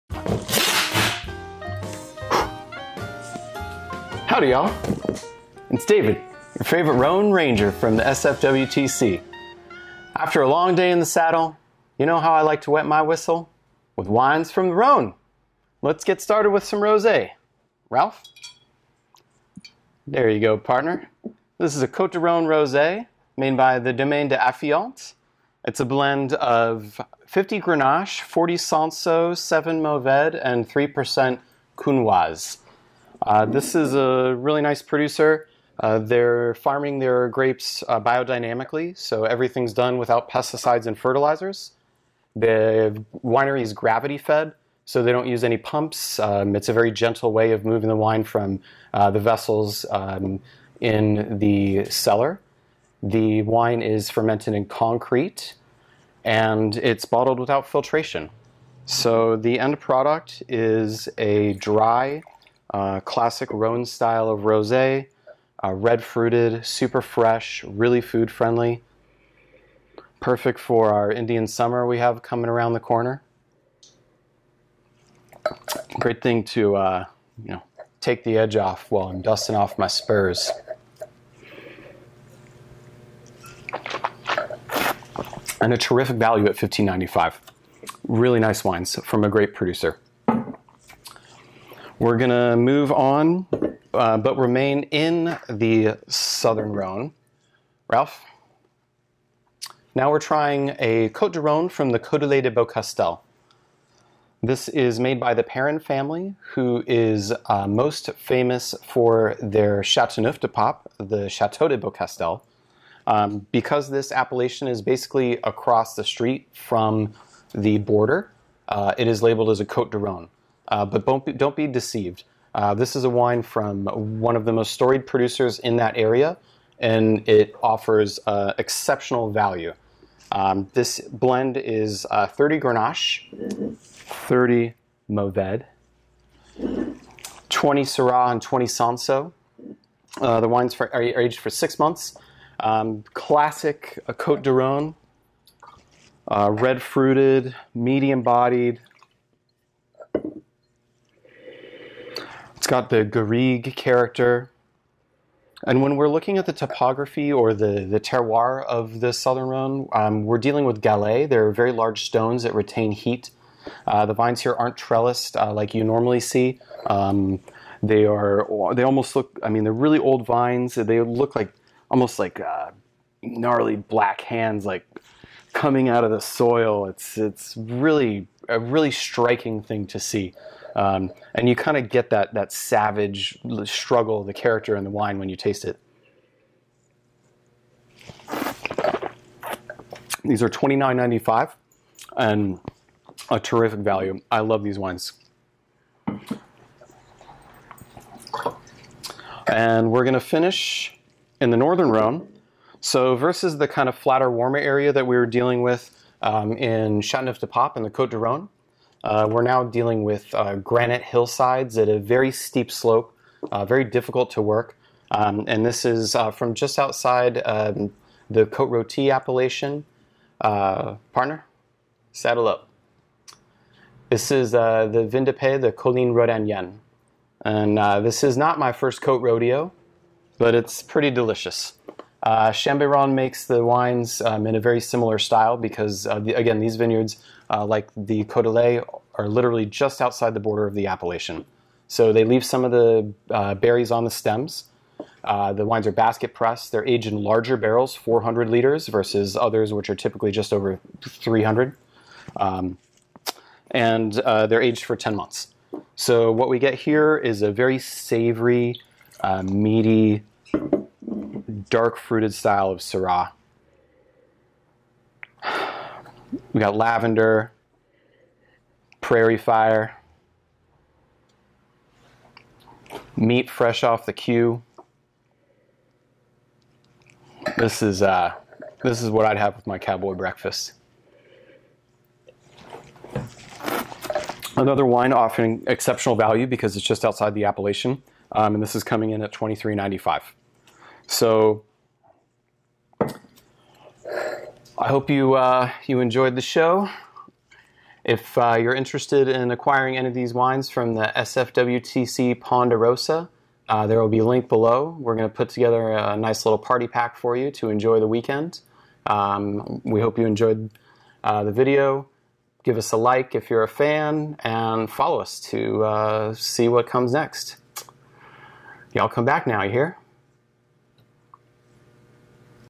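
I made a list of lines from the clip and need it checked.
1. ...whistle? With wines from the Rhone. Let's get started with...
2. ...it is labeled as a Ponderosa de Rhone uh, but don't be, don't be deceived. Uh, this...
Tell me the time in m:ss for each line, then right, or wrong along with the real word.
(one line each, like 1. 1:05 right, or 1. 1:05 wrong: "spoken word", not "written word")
1. 0:13 right
2. 1:58 wrong: "Côte", not "Ponderosa".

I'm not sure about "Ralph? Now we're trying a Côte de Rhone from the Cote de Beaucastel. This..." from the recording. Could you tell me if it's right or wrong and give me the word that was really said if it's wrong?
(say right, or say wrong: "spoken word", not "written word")
right.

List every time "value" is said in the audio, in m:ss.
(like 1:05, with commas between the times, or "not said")
1:26, 2:09, 3:13, 4:46.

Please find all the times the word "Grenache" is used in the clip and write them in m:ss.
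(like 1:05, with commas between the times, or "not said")
0:27, 2:12.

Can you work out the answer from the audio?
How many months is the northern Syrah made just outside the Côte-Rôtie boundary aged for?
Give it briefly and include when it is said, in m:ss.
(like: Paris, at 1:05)
10, at 4:14.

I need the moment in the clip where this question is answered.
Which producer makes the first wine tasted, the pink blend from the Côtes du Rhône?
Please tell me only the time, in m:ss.
0:23.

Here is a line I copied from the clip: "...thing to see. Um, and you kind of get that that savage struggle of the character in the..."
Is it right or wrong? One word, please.
right.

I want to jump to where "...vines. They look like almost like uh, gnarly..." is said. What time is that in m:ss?
2:50.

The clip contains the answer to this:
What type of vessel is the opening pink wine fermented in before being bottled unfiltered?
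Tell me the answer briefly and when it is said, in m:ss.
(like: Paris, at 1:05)
Concrete, at 0:54.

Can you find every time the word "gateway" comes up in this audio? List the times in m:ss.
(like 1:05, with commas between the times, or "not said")
not said.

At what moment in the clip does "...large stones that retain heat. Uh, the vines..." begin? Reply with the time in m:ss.
2:41.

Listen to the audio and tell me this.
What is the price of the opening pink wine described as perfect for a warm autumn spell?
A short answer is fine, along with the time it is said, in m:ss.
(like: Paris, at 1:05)
$15.95, at 1:26.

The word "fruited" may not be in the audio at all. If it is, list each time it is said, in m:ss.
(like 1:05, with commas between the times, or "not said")
1:06, 2:26, 4:21.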